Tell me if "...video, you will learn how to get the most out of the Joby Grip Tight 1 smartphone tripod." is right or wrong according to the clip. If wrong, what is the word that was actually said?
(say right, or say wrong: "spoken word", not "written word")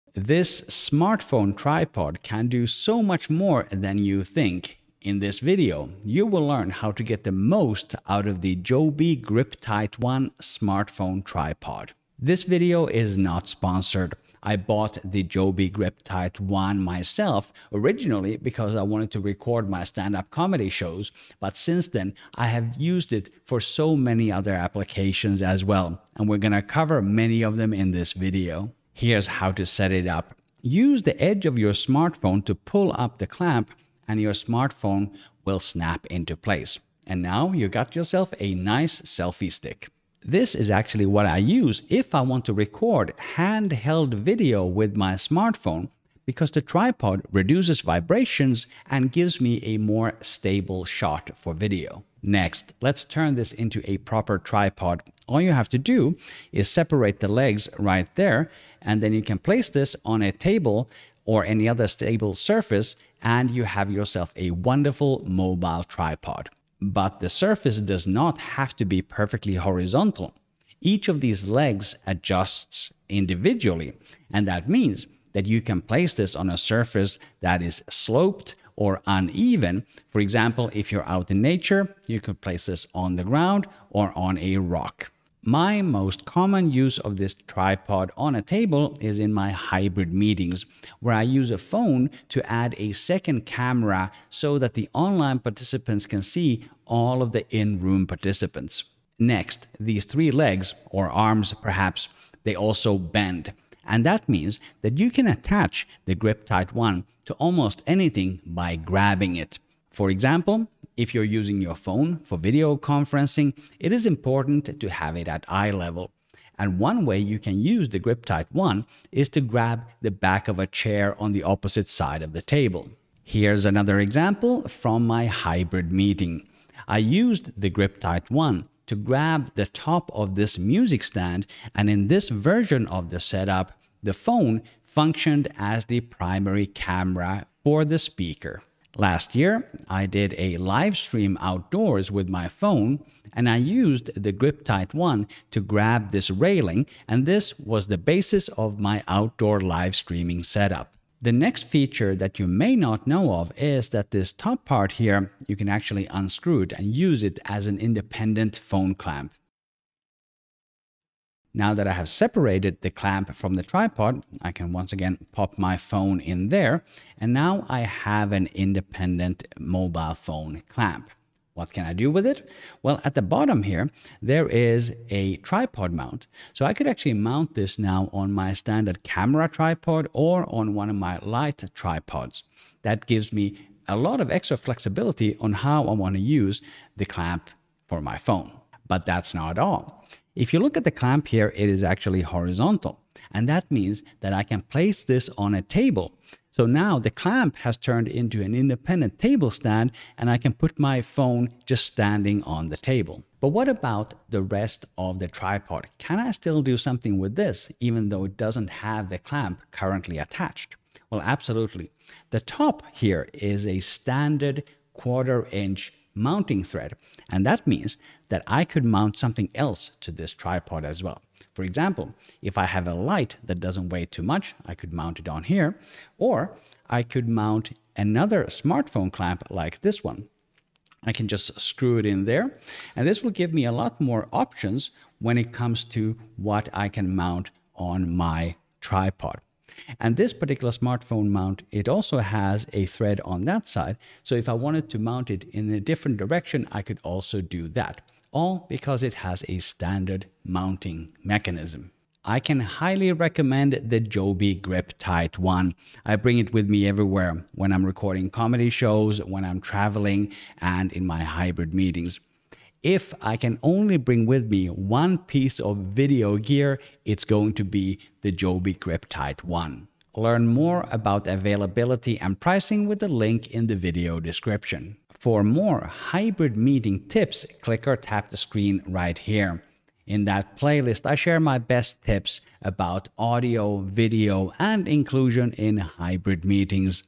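right.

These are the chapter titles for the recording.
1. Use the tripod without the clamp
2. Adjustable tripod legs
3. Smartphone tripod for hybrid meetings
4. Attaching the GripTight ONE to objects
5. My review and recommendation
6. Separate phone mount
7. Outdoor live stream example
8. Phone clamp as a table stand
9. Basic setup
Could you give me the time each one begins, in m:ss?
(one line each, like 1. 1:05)
1. 3:23
2. 1:06
3. 1:25
4. 1:39
5. 4:12
6. 2:31
7. 2:18
8. 3:08
9. 0:28.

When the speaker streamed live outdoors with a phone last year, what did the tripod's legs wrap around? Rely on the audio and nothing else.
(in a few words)
railing.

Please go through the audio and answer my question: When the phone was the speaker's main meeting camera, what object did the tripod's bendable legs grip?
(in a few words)
music stand.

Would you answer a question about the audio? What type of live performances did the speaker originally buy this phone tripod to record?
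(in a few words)
stand-up comedy shows.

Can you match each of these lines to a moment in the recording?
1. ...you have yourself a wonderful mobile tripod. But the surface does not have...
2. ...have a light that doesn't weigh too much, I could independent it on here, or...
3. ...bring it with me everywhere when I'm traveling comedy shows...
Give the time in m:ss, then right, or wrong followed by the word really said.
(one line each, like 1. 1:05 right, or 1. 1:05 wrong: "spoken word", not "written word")
1. 1:03 right
2. 3:42 wrong: "mount", not "independent"
3. 4:16 wrong: "recording", not "traveling".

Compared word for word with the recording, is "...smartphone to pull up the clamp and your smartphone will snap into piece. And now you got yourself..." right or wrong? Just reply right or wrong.
wrong.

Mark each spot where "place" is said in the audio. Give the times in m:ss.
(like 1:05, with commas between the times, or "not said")
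0:36, 0:59, 1:15, 1:22, 3:14.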